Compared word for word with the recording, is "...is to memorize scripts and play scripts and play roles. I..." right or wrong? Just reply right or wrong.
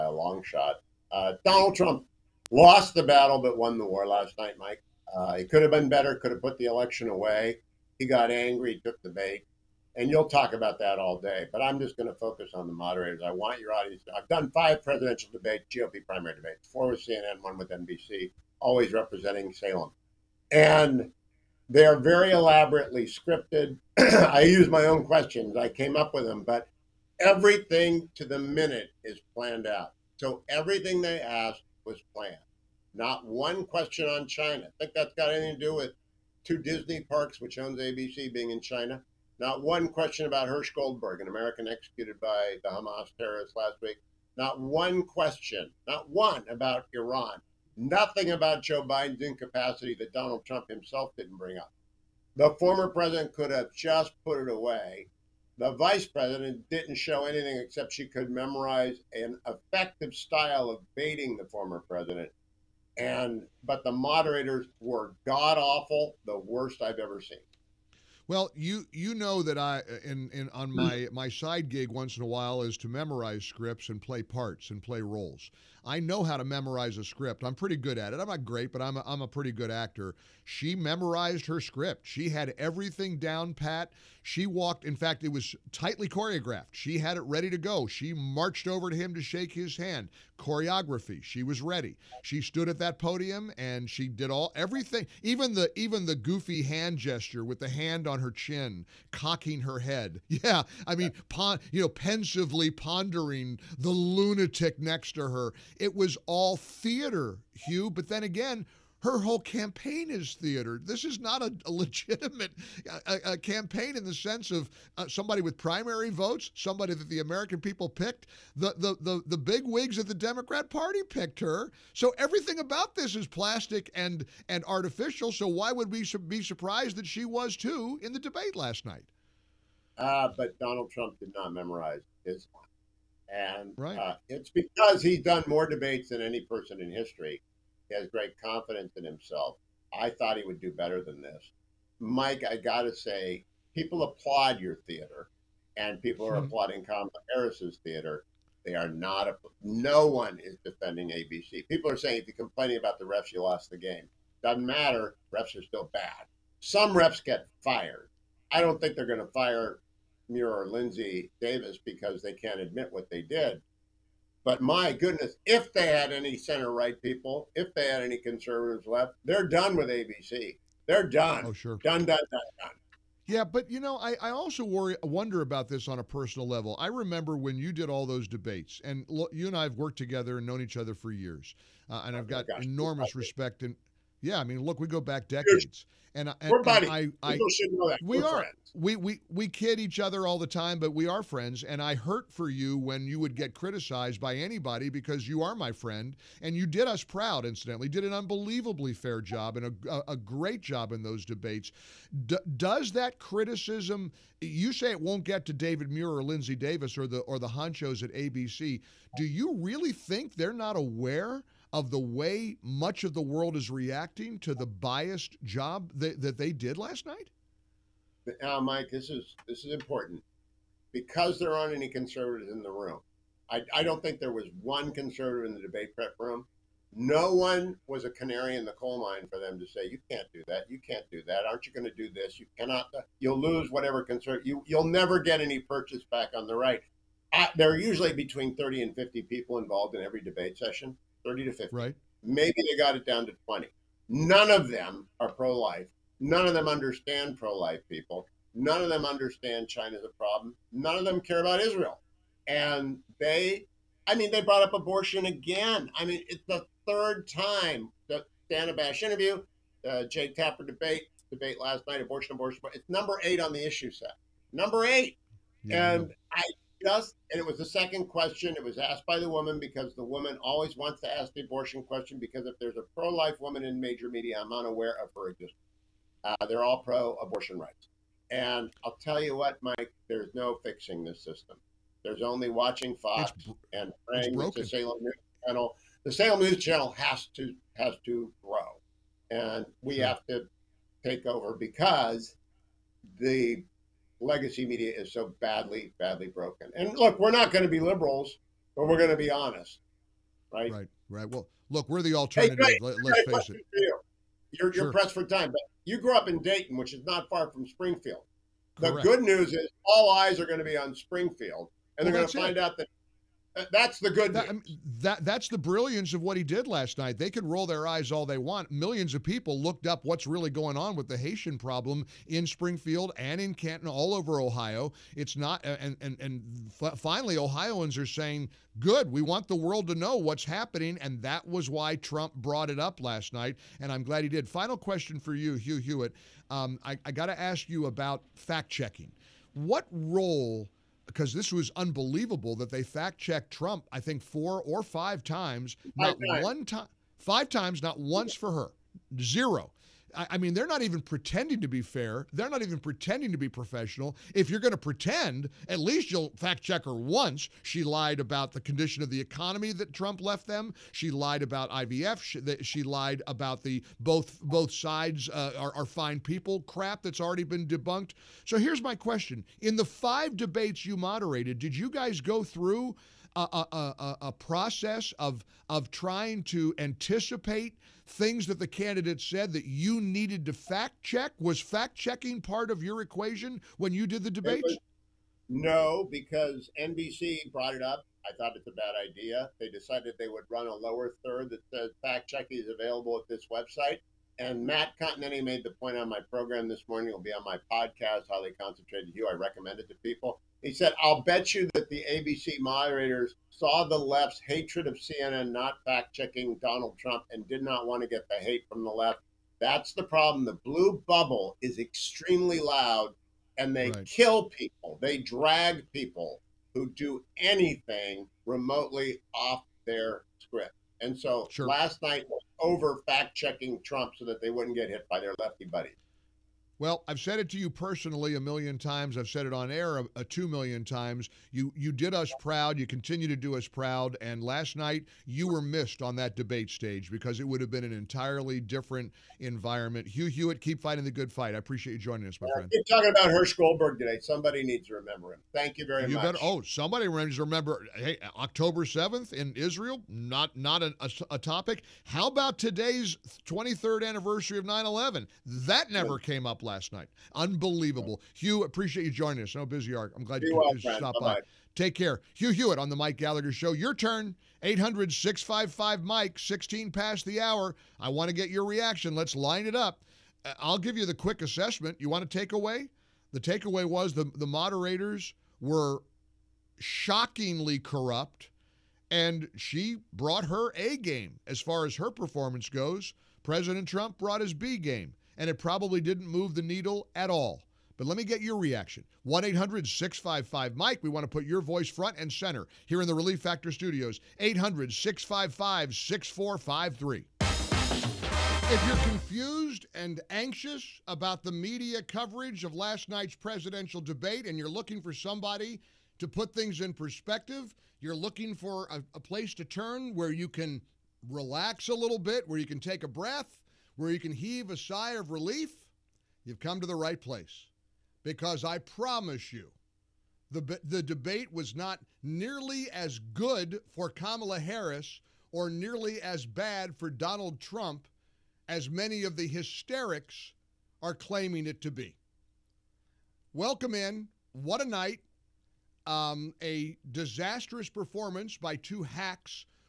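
wrong.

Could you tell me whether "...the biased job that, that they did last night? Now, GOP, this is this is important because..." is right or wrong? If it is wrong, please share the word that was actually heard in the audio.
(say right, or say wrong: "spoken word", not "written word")
wrong: "Mike", not "GOP".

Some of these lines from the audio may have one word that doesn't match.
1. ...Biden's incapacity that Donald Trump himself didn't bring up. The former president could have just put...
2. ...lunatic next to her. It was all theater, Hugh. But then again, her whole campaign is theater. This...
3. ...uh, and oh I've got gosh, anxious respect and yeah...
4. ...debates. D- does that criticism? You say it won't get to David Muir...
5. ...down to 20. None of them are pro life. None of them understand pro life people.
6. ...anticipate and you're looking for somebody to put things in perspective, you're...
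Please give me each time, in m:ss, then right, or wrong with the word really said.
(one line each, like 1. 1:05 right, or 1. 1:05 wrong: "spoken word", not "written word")
1. 0:48 right
2. 1:43 right
3. 3:01 wrong: "enormous", not "anxious"
4. 3:21 right
5. 4:03 right
6. 8:24 wrong: "debate", not "anticipate".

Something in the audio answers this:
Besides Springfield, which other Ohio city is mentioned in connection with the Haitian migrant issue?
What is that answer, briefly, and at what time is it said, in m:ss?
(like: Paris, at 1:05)
Canton, at 5:23.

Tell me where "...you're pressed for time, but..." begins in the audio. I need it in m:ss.
5:04.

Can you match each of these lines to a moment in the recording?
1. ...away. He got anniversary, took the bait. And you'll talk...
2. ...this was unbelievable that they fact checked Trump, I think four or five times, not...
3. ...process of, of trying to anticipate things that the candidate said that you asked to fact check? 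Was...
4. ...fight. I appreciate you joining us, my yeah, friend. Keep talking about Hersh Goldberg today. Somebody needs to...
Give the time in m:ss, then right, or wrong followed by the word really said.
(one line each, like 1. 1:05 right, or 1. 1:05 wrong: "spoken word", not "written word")
1. 0:07 wrong: "angry", not "anniversary"
2. 5:41 right
3. 6:14 wrong: "needed", not "asked"
4. 7:21 right.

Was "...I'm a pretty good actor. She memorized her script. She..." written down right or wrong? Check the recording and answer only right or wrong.
right.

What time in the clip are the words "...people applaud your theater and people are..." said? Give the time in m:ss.
2:23.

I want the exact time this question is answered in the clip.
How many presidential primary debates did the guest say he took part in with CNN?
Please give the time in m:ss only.
0:16.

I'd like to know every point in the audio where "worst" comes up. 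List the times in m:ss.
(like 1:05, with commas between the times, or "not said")
1:06.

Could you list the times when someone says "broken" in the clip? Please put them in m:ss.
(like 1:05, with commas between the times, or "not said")
4:56.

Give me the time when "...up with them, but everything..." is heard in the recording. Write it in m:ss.
0:25.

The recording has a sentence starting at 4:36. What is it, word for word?
Uh, they're all pro abortion rights.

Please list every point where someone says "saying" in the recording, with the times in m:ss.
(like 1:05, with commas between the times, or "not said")
2:31, 5:28.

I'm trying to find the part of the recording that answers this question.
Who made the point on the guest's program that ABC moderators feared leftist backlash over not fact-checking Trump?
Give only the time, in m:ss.
6:34.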